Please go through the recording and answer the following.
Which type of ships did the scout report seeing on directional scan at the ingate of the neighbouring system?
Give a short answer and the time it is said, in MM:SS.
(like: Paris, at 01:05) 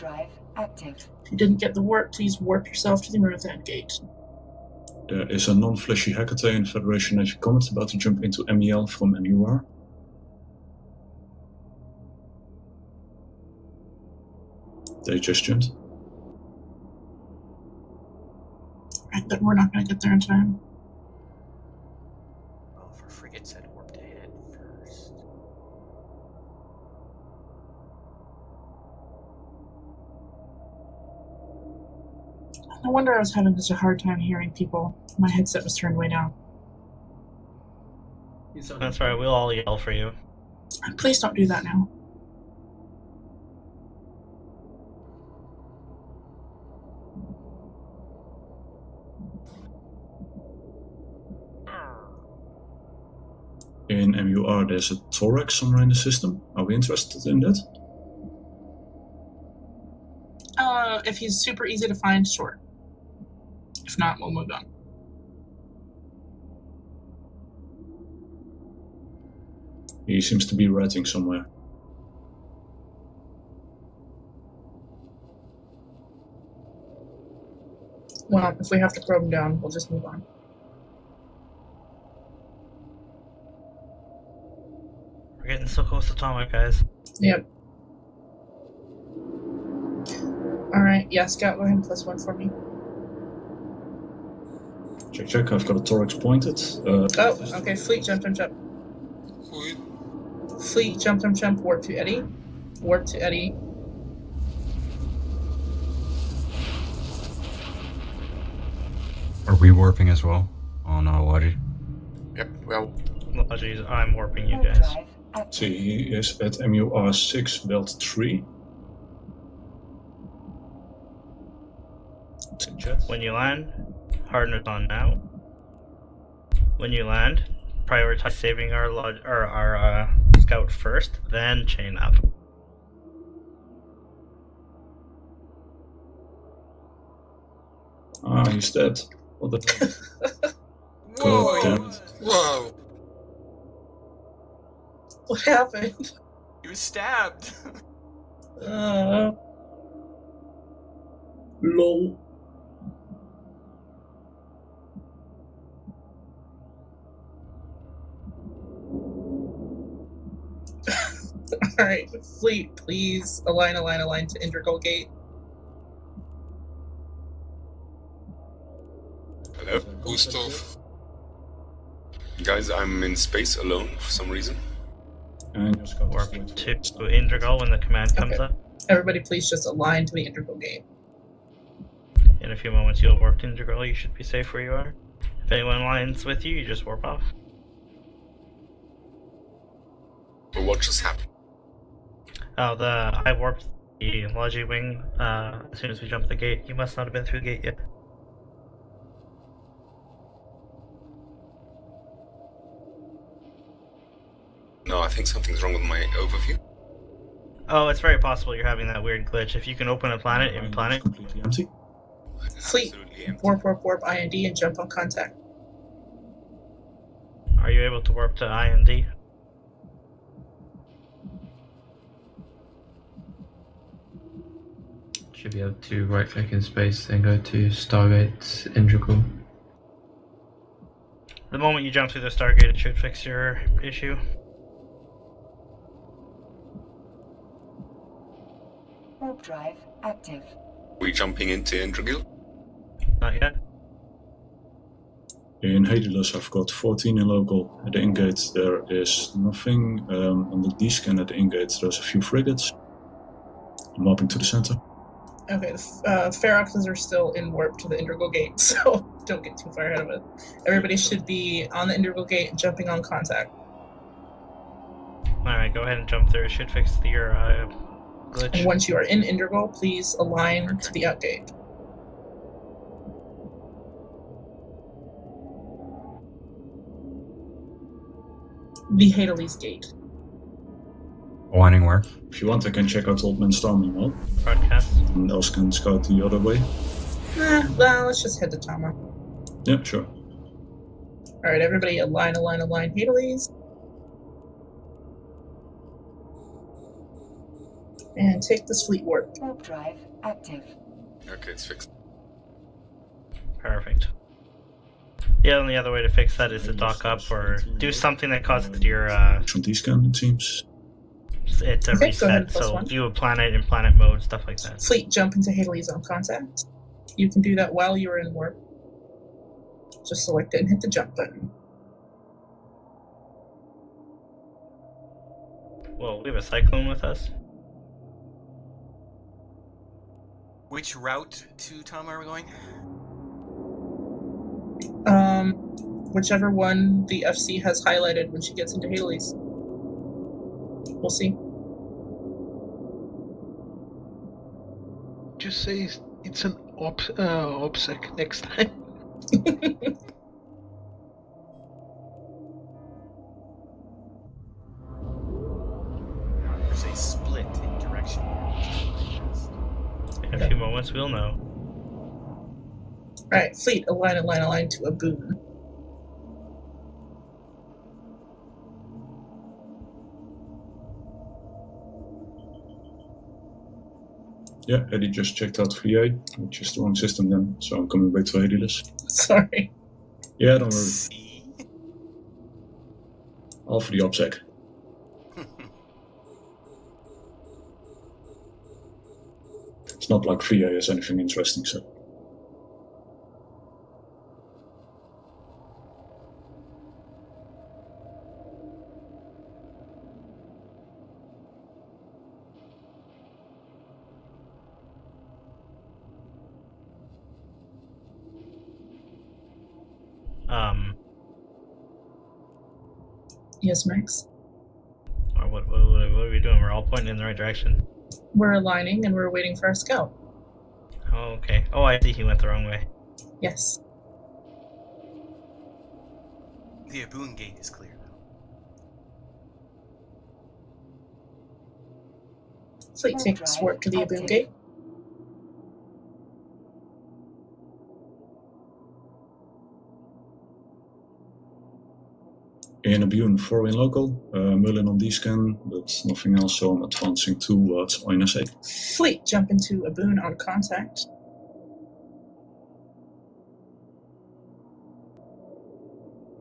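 frigates, at 04:12.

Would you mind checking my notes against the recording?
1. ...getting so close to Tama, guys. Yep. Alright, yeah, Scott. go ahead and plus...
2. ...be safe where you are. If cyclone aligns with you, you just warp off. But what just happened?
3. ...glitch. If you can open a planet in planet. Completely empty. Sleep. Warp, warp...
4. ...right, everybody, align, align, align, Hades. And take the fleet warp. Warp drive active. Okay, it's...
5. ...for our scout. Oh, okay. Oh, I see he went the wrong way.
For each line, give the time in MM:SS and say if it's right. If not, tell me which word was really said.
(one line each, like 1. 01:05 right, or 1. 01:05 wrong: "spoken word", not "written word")
1. 01:25 right
2. 03:04 wrong: "anyone", not "cyclone"
3. 03:29 right
4. 04:51 right
5. 06:59 right.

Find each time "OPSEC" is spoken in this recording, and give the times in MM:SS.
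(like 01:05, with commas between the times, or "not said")
05:47, 06:23.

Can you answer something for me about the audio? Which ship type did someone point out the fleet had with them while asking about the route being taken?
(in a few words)
cyclone.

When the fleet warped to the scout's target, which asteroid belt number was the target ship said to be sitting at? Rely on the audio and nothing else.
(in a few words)
belt 3.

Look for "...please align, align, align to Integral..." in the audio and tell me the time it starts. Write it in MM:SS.
02:42.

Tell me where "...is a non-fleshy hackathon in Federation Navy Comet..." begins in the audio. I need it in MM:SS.
00:05.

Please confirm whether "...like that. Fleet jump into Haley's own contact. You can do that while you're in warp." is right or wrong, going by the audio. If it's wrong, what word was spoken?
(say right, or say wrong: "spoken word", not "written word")
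right.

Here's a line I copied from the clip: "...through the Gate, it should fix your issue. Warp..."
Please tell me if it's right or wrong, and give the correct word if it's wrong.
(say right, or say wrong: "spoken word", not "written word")
wrong: "Stargate", not "Gate".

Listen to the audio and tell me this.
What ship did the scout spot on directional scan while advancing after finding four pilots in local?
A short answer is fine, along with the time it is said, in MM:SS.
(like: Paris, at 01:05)
Merlin, at 07:24.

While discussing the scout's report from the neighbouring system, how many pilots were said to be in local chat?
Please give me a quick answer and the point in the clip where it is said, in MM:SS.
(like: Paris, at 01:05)
14, at 04:06.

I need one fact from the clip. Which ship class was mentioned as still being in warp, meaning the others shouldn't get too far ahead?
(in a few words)
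Feroxes.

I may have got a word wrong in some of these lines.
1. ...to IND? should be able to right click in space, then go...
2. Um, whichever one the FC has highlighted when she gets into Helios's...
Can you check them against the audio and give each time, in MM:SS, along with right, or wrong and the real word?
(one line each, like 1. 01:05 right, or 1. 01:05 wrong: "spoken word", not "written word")
1. 03:38 right
2. 05:35 wrong: "Haley", not "Helios".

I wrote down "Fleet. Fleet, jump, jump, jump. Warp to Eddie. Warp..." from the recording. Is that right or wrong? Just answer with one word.
right.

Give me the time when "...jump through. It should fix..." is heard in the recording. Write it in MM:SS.
04:26.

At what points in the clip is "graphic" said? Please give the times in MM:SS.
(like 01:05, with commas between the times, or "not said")
not said.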